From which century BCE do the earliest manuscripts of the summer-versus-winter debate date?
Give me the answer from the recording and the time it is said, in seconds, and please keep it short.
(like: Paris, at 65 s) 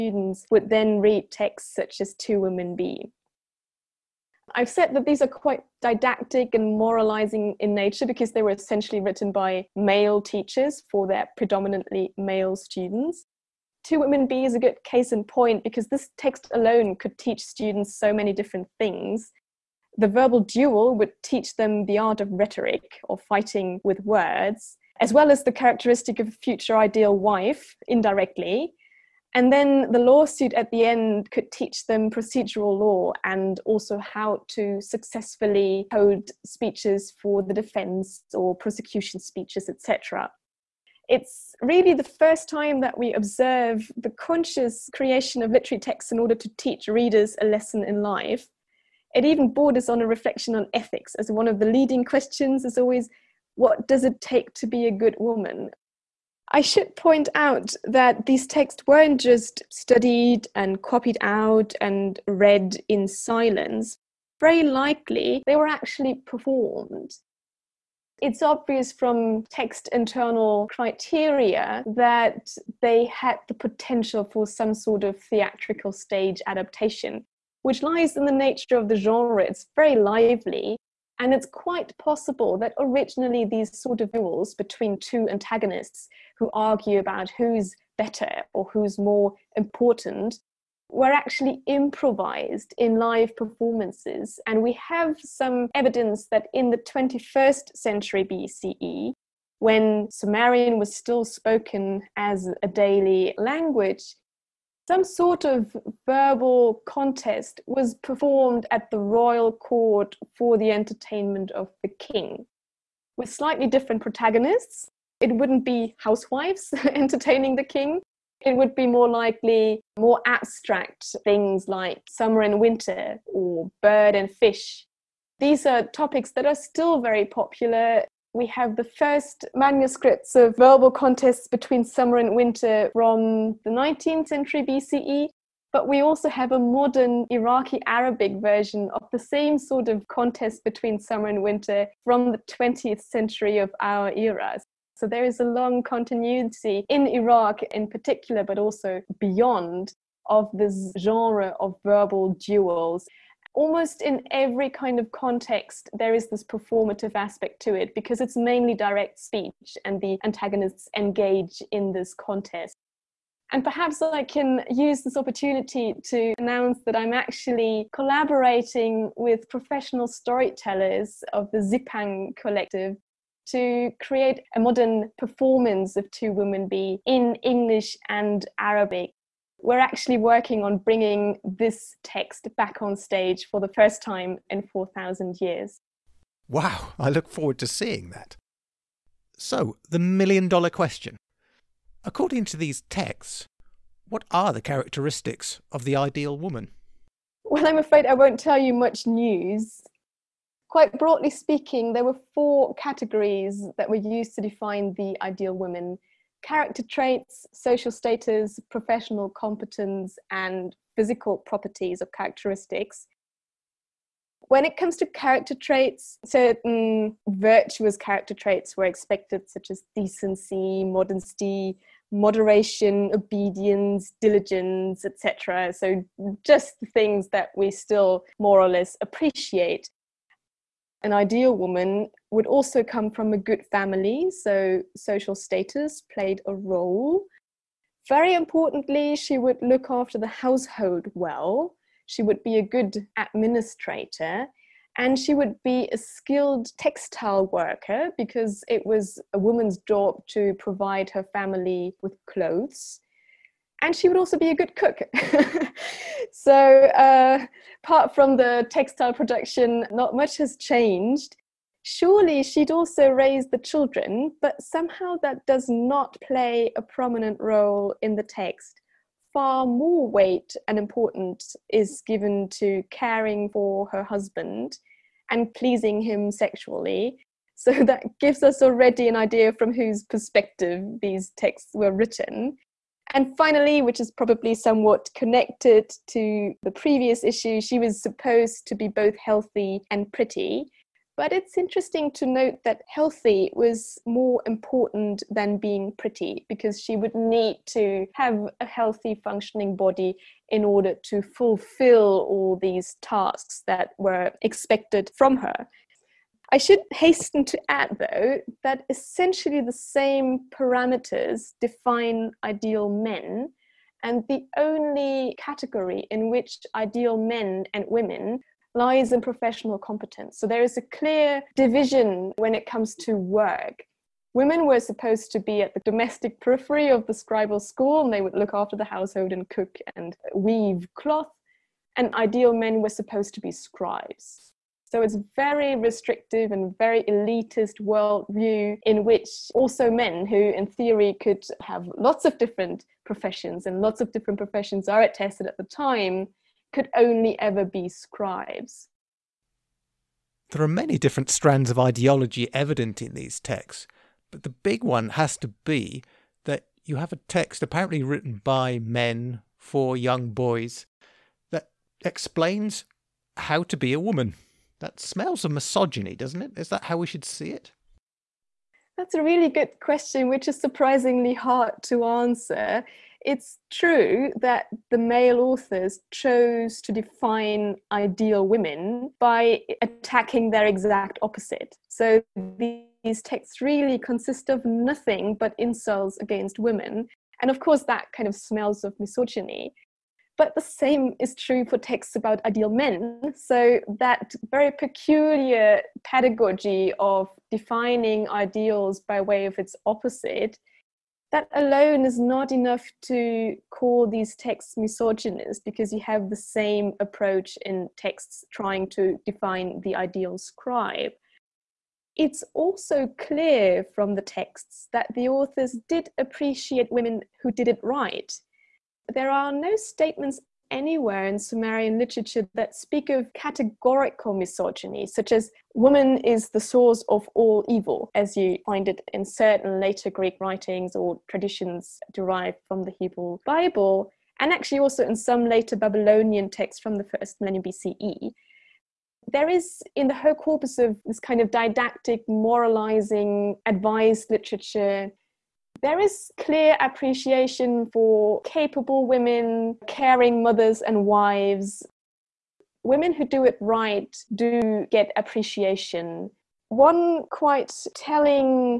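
19th century BCE, at 133 s.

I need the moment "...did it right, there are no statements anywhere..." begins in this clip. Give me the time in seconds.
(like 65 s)
417 s.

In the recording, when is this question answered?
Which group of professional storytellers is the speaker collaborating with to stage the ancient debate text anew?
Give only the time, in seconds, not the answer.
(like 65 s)
171 s.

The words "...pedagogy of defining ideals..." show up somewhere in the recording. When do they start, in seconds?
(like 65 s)
396 s.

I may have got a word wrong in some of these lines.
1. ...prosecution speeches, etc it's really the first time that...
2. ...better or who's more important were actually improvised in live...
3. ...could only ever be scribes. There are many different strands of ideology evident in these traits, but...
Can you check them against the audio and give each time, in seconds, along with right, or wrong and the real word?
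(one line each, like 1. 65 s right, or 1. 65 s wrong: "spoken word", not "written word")
1. 38 s right
2. 87 s right
3. 346 s wrong: "texts", not "traits".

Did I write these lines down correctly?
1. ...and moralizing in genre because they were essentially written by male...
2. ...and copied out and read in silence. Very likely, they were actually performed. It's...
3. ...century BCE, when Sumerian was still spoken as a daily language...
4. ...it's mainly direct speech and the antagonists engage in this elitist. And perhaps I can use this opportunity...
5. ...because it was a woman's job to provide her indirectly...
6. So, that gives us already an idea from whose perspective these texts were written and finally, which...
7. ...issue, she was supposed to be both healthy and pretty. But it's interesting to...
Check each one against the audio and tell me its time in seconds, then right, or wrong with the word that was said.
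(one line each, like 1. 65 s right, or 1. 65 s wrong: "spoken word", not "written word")
1. 6 s wrong: "nature", not "genre"
2. 60 s right
3. 97 s right
4. 158 s wrong: "contest", not "elitist"
5. 248 s wrong: "family", not "indirectly"
6. 277 s right
7. 287 s right.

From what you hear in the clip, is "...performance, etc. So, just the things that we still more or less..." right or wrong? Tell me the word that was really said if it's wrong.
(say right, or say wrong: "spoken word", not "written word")
wrong: "diligence", not "performance".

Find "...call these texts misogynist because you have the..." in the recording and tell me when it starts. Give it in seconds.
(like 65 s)
403 s.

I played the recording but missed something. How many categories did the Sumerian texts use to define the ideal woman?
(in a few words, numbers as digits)
4.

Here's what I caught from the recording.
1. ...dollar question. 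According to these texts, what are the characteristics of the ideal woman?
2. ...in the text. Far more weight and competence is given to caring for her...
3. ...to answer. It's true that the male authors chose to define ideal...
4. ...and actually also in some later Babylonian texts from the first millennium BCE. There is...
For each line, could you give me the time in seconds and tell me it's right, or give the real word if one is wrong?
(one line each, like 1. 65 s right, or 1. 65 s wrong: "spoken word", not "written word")
1. 190 s right
2. 268 s wrong: "importance", not "competence"
3. 371 s right
4. 434 s right.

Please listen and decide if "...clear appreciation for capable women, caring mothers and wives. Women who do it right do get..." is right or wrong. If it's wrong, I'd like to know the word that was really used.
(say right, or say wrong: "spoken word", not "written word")
right.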